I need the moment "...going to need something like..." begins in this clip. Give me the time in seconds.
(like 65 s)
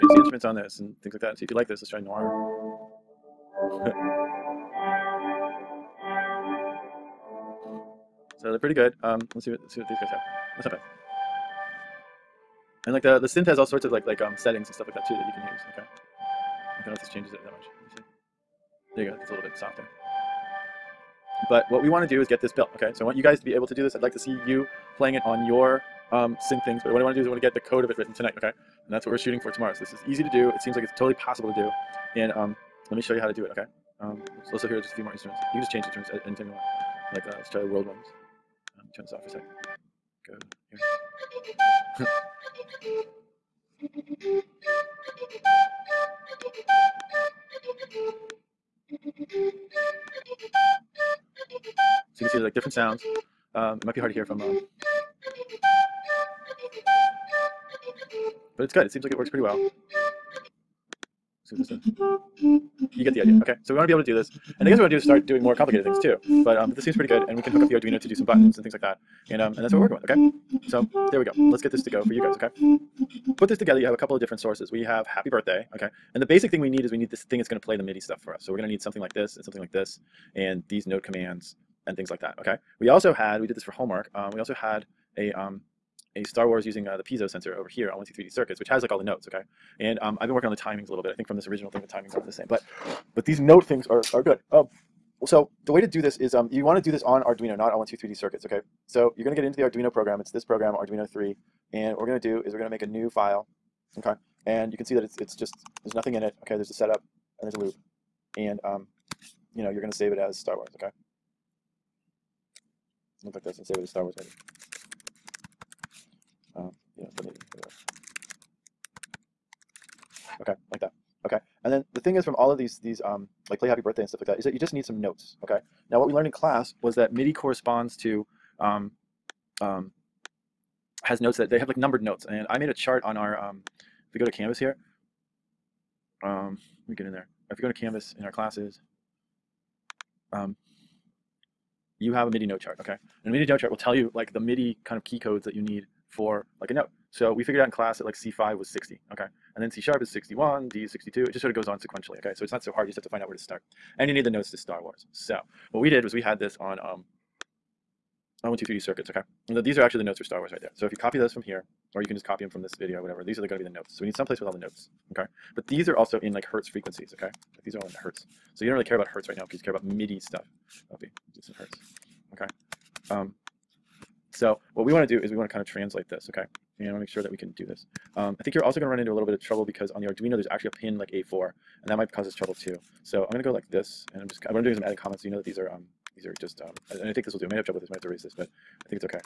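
78 s.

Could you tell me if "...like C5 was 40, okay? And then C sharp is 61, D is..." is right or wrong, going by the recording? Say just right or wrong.
wrong.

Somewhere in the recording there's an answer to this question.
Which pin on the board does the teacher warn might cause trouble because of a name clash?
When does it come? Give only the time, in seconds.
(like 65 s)
181 s.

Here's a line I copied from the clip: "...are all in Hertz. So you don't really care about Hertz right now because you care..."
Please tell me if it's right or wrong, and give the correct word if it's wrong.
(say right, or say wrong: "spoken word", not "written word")
right.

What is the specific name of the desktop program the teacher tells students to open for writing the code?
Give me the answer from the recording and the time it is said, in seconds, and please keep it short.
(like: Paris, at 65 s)
Arduino 3, at 100 s.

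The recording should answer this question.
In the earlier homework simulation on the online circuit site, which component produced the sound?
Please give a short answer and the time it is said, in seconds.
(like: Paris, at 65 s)
piezo sensor, at 87 s.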